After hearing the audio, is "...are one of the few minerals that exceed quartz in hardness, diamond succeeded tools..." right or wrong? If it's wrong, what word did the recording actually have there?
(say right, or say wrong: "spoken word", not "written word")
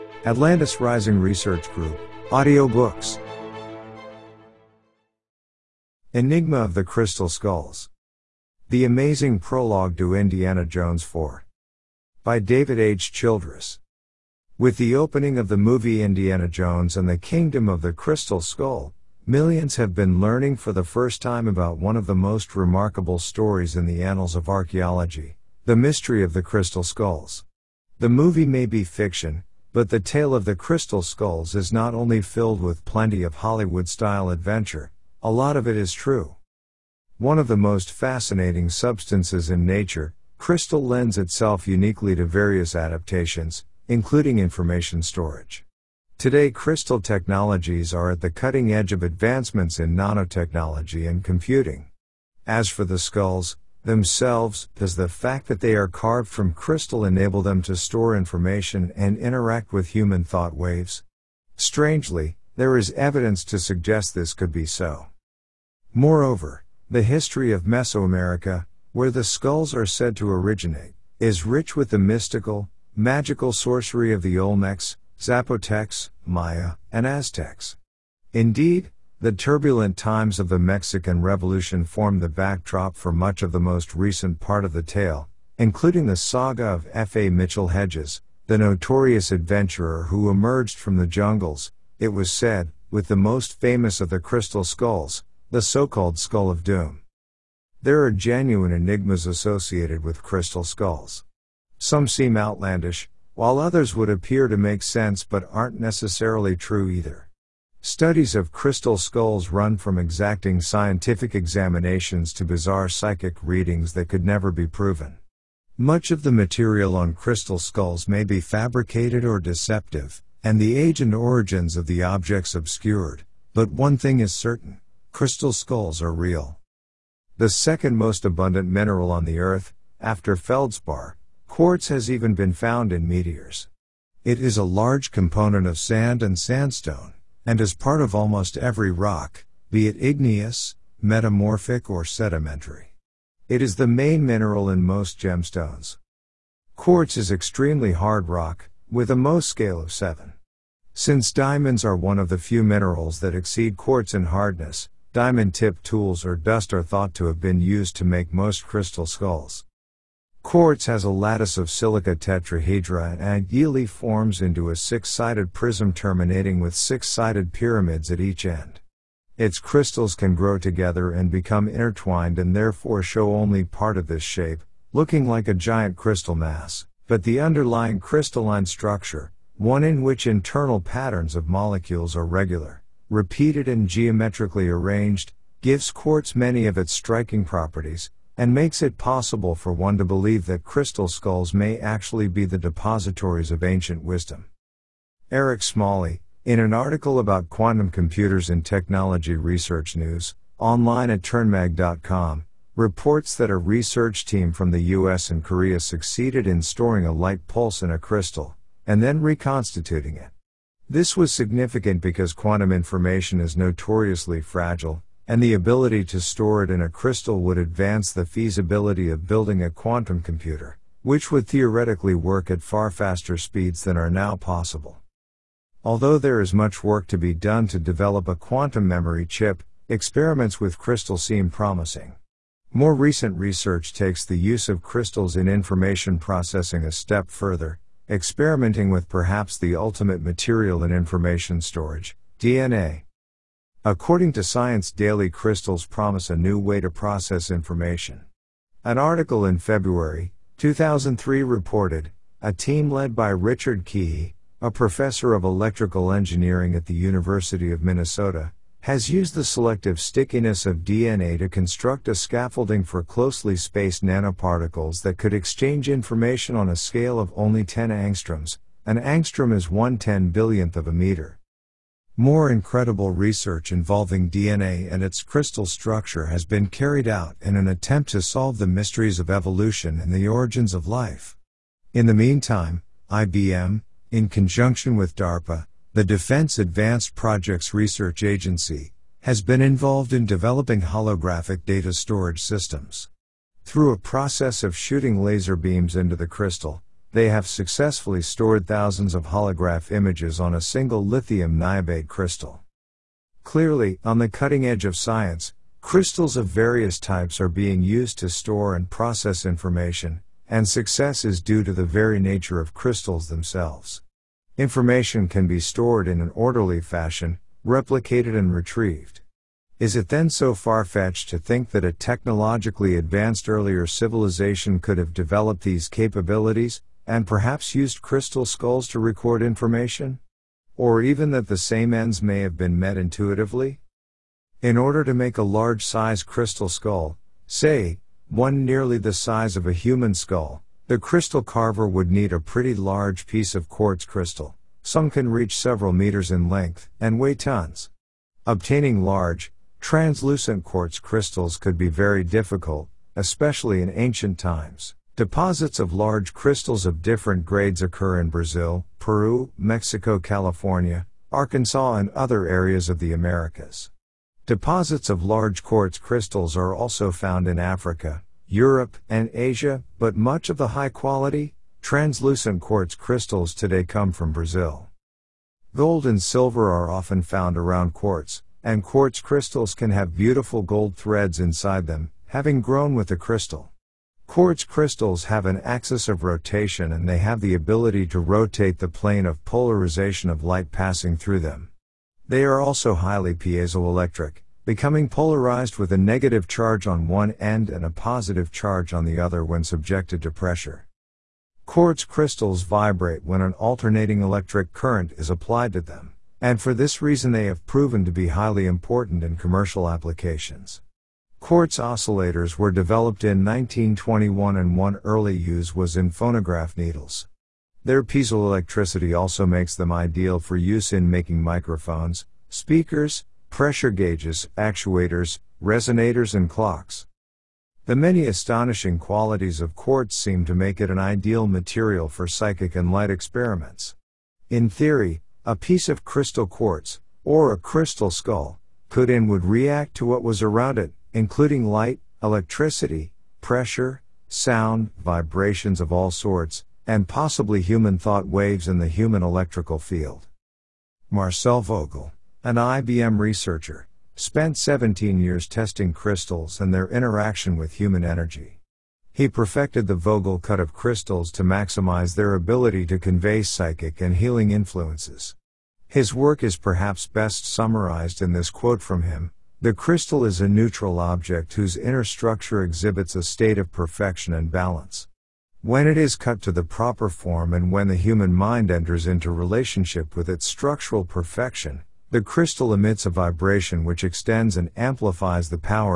wrong: "tipped", not "succeeded".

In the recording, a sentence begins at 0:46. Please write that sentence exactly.
Today, crystal technologies are at the cutting edge of advancements in nanotechnology and computing.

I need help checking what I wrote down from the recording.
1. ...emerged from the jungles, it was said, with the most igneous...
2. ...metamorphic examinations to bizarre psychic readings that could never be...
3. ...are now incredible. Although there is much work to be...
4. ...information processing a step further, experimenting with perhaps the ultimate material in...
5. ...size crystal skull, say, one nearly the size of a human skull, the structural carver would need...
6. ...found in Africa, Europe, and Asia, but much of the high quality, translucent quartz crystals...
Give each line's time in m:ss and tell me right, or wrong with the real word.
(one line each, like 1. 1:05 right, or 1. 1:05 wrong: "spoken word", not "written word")
1. 1:30 wrong: "famous", not "igneous"
2. 1:50 wrong: "scientific", not "metamorphic"
3. 3:43 wrong: "possible", not "incredible"
4. 3:55 right
5. 5:35 wrong: "crystal", not "structural"
6. 6:07 right.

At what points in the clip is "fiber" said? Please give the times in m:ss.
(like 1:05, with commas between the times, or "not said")
not said.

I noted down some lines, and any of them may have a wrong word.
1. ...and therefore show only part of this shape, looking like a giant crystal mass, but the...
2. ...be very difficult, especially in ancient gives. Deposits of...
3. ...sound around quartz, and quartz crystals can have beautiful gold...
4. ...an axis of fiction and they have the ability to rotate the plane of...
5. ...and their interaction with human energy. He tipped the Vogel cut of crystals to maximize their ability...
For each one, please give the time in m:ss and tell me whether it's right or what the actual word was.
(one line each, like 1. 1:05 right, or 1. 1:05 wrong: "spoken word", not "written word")
1. 2:52 right
2. 5:51 wrong: "times", not "gives"
3. 6:17 wrong: "found", not "sound"
4. 6:25 wrong: "rotation", not "fiction"
5. 7:36 wrong: "perfected", not "tipped".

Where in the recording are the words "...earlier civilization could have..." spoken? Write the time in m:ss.
5:23.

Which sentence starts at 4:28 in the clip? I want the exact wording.
An angstrom is 1/10 billionth of a meter.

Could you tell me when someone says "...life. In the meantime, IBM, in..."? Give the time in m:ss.
4:40.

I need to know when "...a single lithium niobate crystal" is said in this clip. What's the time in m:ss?
5:00.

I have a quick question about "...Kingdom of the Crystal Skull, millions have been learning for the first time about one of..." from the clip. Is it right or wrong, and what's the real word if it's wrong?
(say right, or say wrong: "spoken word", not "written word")
right.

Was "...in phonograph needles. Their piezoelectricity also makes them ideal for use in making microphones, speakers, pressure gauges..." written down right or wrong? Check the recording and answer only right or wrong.
right.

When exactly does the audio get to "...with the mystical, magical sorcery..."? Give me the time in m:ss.
1:11.